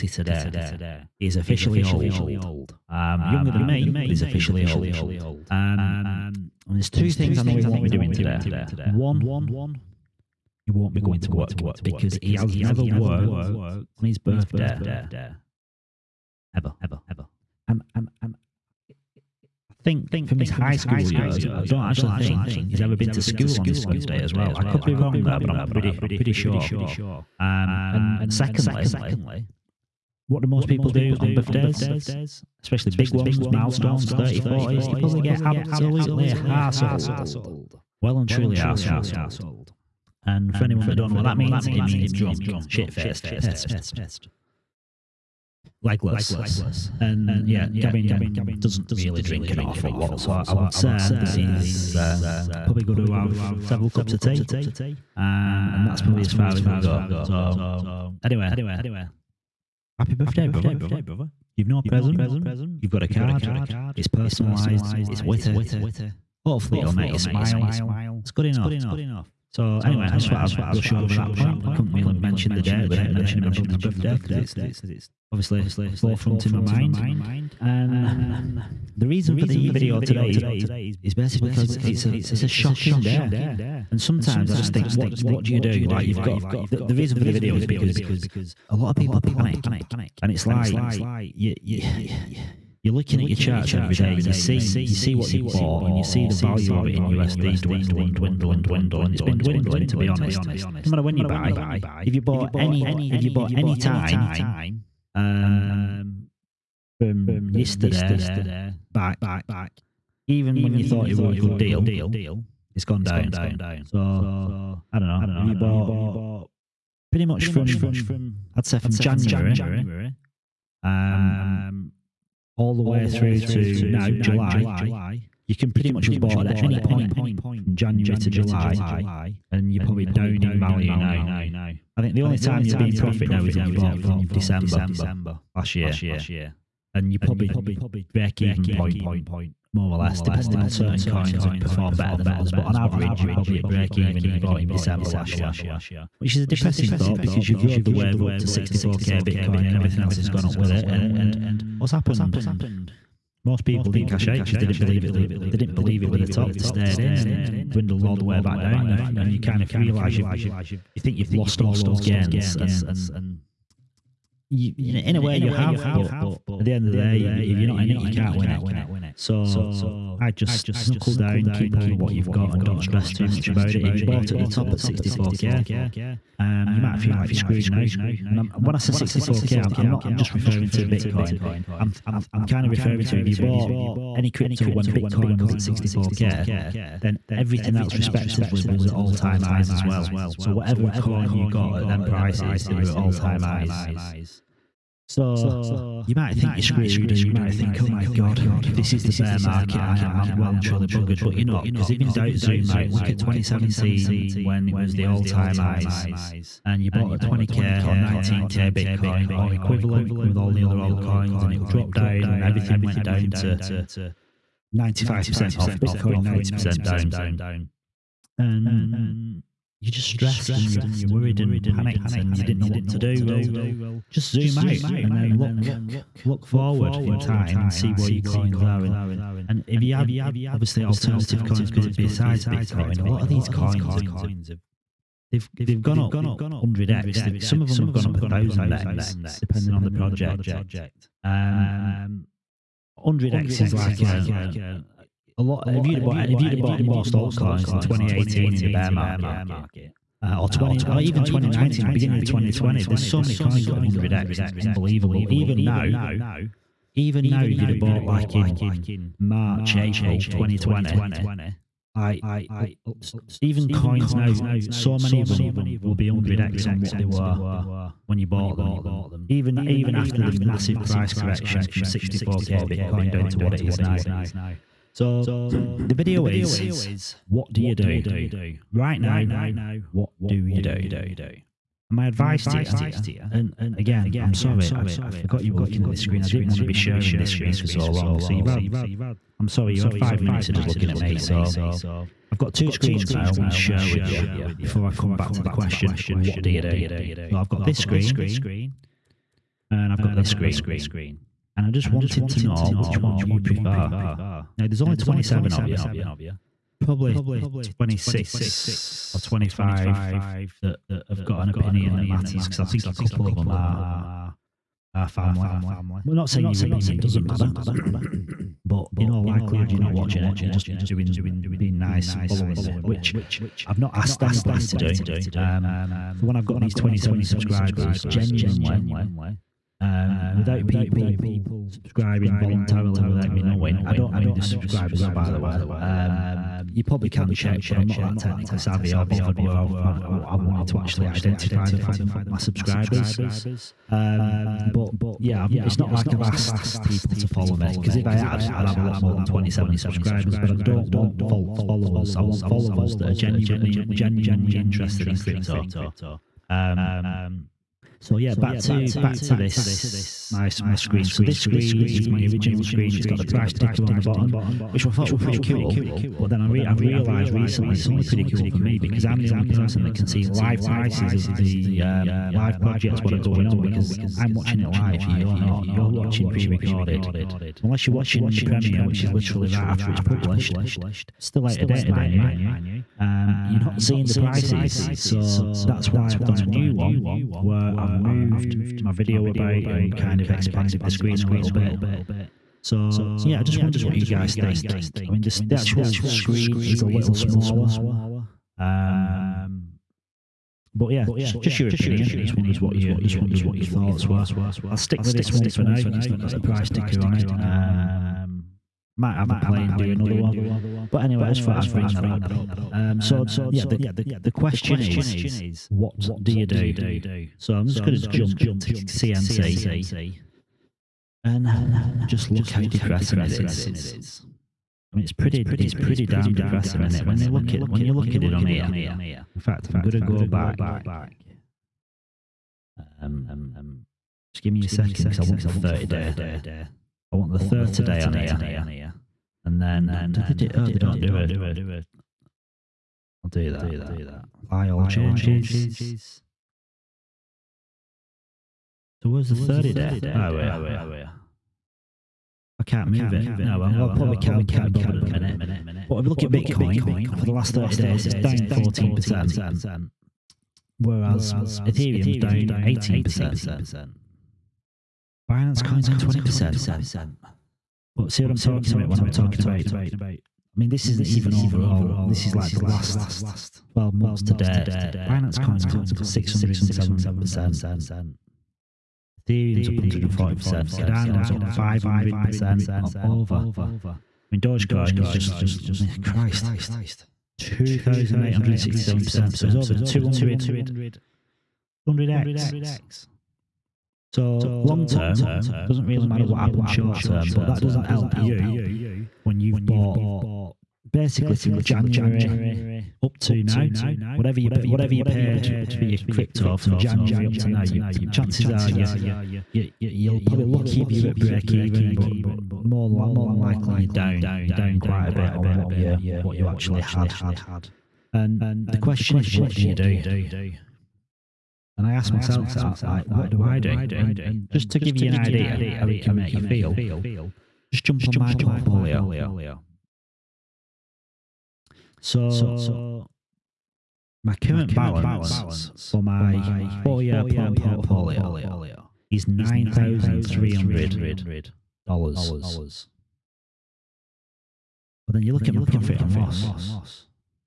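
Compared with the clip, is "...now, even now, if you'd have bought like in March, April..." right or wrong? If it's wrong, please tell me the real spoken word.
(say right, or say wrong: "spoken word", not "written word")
right.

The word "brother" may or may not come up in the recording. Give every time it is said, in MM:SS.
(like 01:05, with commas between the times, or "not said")
01:00, 01:13.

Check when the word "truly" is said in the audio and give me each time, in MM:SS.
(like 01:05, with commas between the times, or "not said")
00:38, 03:20.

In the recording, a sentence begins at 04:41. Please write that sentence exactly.
And my advice to you, and again, I'm sorry, I, I forgot you were looking at this screen.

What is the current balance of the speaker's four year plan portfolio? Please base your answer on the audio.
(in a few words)
$9,300.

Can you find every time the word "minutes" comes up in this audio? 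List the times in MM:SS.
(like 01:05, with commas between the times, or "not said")
04:50, 07:35.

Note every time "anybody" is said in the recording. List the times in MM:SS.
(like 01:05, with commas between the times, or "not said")
05:24.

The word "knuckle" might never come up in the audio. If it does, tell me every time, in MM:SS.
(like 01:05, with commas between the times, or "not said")
02:50.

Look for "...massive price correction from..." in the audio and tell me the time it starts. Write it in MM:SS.
04:30.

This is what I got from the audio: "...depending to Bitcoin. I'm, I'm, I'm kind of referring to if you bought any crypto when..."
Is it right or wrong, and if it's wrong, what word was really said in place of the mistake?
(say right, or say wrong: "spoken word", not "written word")
wrong: "referring", not "depending".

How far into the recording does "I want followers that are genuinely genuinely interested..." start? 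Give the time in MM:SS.
05:52.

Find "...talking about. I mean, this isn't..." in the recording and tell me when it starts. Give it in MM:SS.
07:49.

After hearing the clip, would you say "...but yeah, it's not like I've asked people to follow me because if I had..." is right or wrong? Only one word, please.
right.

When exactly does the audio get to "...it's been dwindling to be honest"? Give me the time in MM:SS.
01:39.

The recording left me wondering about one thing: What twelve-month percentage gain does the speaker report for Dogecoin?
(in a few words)
2,867%.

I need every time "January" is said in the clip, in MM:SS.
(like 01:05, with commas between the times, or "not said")
01:58, 02:07, 08:21, 08:26.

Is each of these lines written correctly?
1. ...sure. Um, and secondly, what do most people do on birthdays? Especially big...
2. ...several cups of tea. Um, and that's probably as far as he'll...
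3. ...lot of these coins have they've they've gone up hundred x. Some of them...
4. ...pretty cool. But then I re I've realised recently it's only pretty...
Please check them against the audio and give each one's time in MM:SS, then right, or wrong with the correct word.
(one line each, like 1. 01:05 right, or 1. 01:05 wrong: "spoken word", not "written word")
1. 00:26 right
2. 00:53 right
3. 03:53 right
4. 06:05 right.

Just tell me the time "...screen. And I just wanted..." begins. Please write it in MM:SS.
05:00.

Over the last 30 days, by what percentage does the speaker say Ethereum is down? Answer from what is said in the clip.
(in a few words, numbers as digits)
18%.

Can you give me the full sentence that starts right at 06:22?
Um, you're not seeing the prices.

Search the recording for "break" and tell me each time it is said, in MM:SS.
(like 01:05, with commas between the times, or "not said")
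02:18, 02:23, 08:31.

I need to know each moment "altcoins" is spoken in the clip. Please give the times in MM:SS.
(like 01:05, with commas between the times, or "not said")
03:30, 04:07.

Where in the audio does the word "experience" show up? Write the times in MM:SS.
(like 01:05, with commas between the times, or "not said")
not said.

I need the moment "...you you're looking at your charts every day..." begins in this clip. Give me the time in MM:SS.
01:31.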